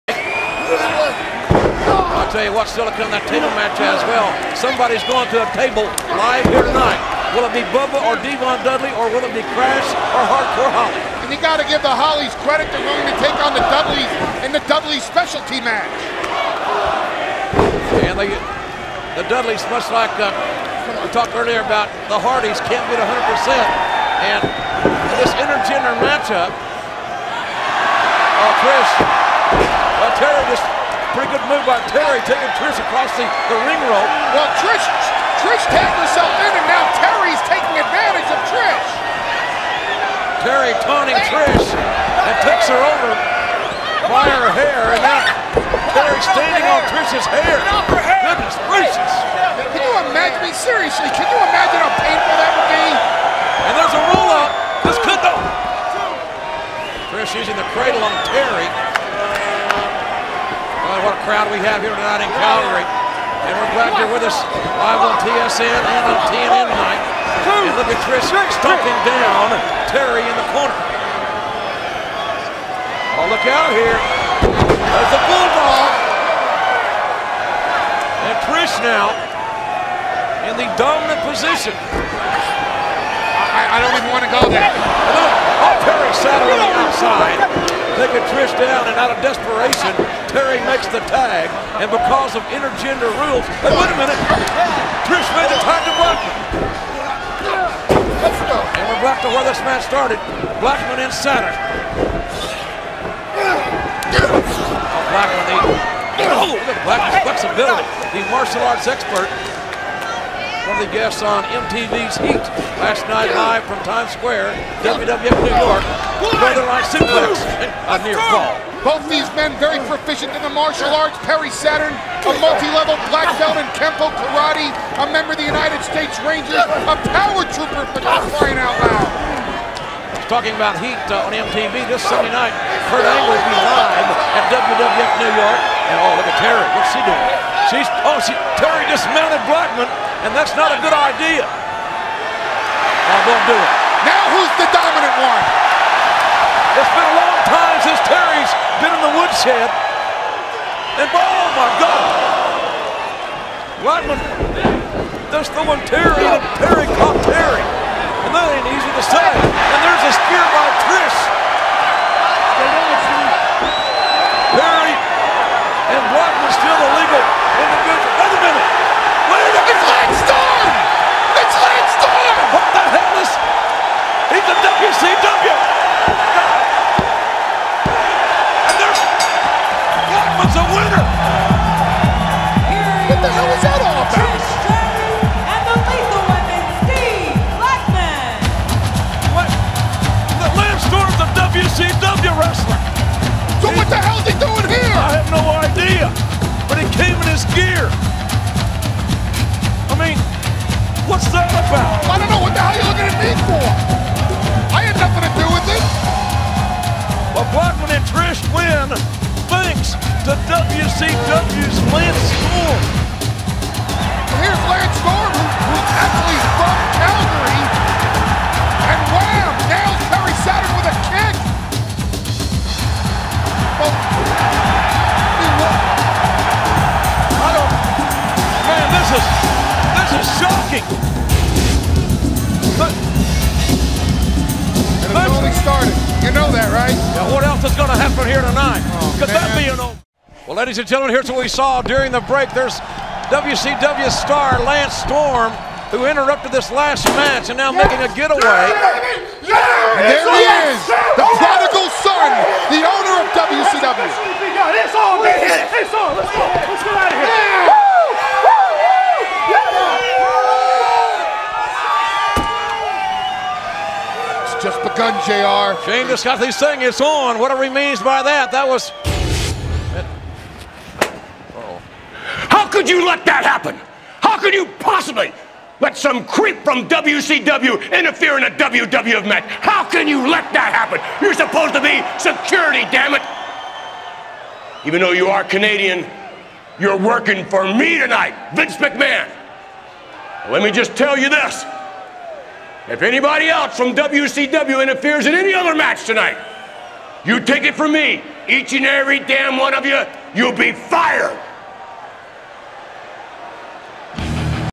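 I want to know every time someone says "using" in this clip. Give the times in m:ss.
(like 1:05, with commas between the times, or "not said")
0:57.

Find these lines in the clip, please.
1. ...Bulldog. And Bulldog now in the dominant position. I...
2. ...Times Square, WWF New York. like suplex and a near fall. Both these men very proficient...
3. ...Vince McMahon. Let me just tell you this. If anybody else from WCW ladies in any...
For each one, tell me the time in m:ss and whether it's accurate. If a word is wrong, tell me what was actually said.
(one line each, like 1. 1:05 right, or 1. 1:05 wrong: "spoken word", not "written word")
1. 1:15 wrong: "Trish", not "Bulldog"
2. 1:53 right
3. 4:48 wrong: "interferes", not "ladies".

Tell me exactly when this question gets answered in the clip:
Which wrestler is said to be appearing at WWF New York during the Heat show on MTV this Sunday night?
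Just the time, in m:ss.
2:12.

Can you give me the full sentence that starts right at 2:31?
And oh my God, Blackman just throwing Terri, and Terry caught Terri, and that ain't easy to say.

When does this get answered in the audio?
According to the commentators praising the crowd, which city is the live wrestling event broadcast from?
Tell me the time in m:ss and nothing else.
1:02.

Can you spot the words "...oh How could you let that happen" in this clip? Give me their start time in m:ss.
4:31.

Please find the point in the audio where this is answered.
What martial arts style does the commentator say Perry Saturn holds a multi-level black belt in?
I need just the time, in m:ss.
2:03.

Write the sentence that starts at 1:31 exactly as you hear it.
And because of intergender rules, hey, wait a minute, Trish made the tag to Blackman.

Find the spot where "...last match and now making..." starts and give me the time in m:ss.
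4:06.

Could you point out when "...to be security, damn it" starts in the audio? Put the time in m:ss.
4:41.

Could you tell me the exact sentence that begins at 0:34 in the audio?
Well, Trish, Trish tapped herself in, and now Terri's taking advantage of Trish.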